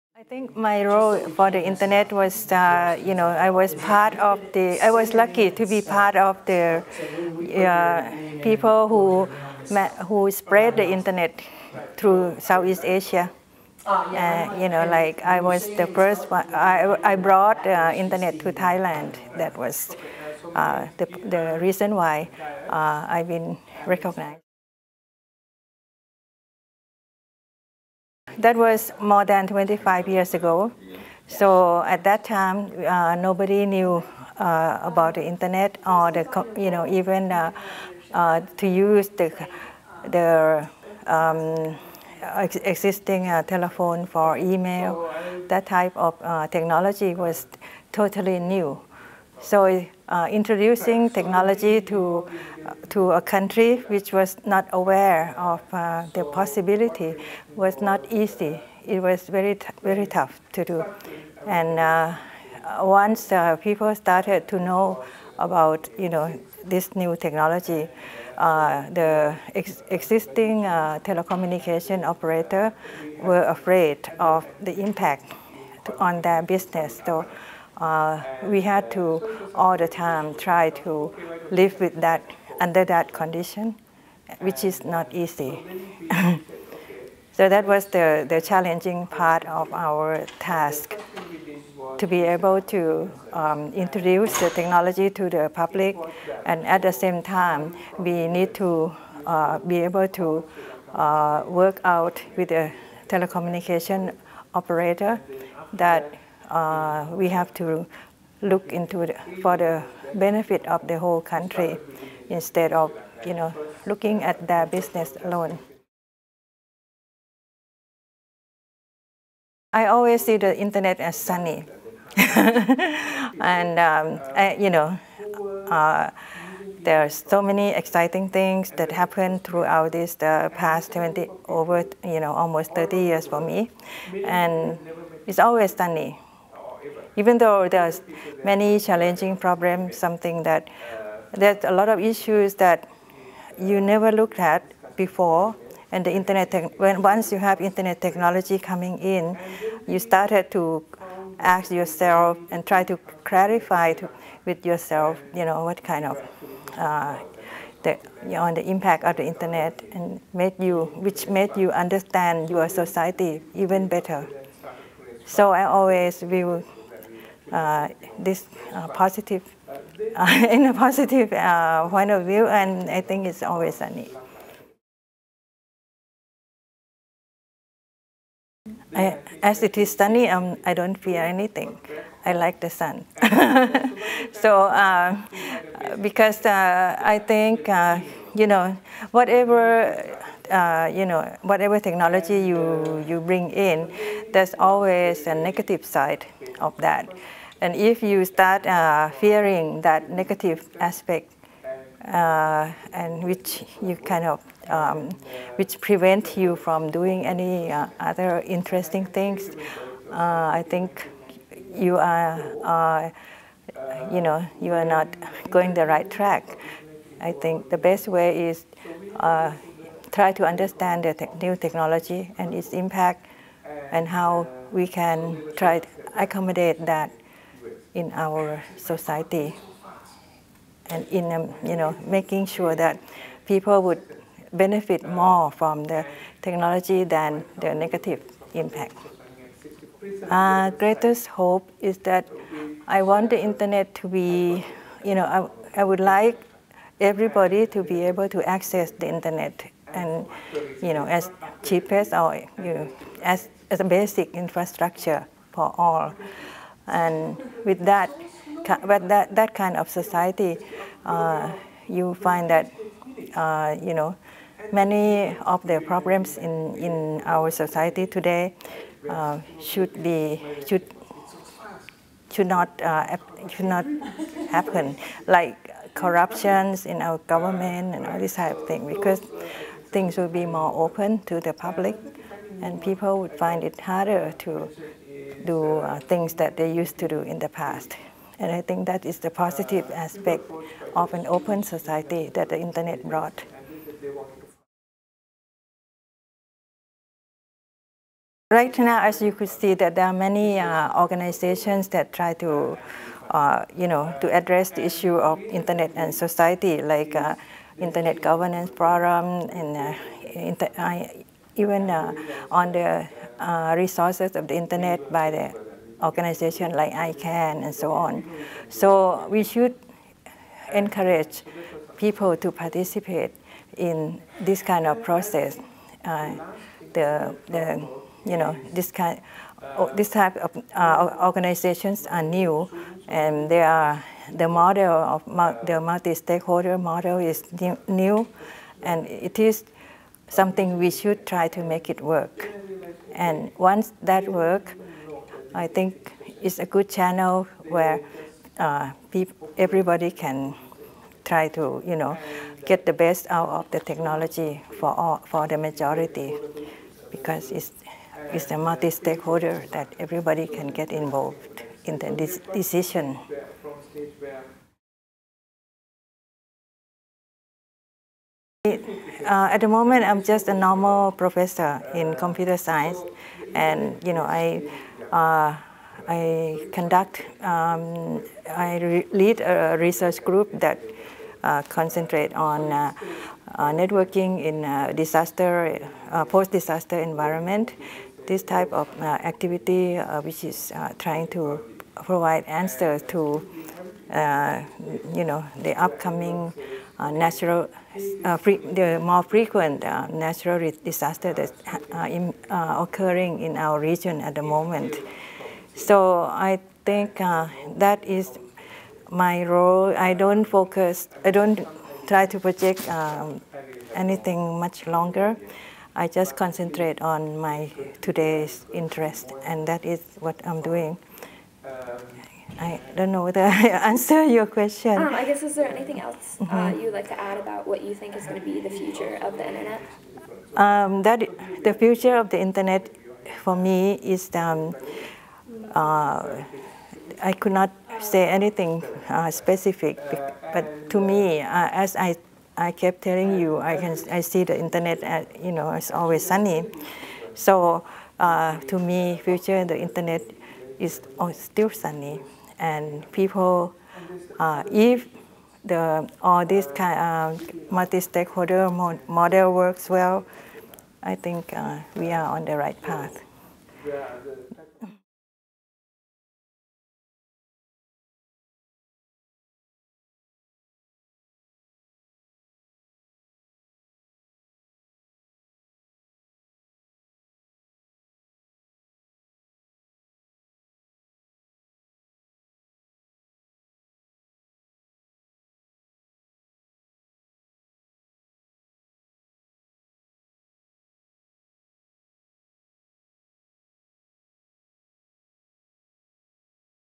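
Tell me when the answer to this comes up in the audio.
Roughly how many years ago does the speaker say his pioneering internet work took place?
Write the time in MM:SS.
00:28.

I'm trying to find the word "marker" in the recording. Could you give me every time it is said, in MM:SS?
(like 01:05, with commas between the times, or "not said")
not said.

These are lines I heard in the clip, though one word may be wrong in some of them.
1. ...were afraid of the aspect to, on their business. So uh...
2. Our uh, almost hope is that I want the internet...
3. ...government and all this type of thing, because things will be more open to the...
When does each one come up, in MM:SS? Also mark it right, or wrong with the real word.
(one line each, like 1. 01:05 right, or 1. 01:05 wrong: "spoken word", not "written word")
1. 01:13 wrong: "impact", not "aspect"
2. 04:00 wrong: "greatest", not "almost"
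3. 04:37 right.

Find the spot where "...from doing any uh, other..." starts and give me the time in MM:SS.
03:26.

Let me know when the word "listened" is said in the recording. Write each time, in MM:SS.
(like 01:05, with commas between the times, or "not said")
not said.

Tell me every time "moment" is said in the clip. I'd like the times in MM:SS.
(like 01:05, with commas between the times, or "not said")
06:09, 06:44.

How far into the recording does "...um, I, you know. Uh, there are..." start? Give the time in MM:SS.
02:03.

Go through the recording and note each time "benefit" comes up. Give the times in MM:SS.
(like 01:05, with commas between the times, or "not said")
01:50, 03:54.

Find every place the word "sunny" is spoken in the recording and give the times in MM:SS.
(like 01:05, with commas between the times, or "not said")
02:01, 02:15, 02:59, 07:26, 07:31.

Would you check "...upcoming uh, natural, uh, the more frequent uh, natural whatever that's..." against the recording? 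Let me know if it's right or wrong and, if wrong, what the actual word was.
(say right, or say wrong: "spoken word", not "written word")
wrong: "disaster", not "whatever".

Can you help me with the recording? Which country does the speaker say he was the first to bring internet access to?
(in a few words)
Thailand.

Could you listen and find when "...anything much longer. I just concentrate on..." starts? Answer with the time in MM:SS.
06:53.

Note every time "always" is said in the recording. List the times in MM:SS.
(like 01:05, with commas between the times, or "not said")
01:59, 02:15, 02:45, 02:53, 03:14, 07:25.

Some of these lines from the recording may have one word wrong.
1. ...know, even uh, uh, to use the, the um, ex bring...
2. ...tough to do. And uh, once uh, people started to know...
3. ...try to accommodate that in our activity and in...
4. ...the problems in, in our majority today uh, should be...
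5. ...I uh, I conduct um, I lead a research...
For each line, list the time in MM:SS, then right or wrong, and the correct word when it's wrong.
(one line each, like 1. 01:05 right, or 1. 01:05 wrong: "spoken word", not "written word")
1. 00:36 wrong: "existing", not "bring"
2. 01:00 right
3. 03:45 wrong: "society", not "activity"
4. 04:25 wrong: "society", not "majority"
5. 06:14 right.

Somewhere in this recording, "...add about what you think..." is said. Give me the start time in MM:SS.
07:07.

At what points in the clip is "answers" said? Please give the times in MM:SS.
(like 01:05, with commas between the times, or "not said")
06:32, 07:03.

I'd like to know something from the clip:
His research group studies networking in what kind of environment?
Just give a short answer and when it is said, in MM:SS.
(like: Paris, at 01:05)
post-disaster, at 06:26.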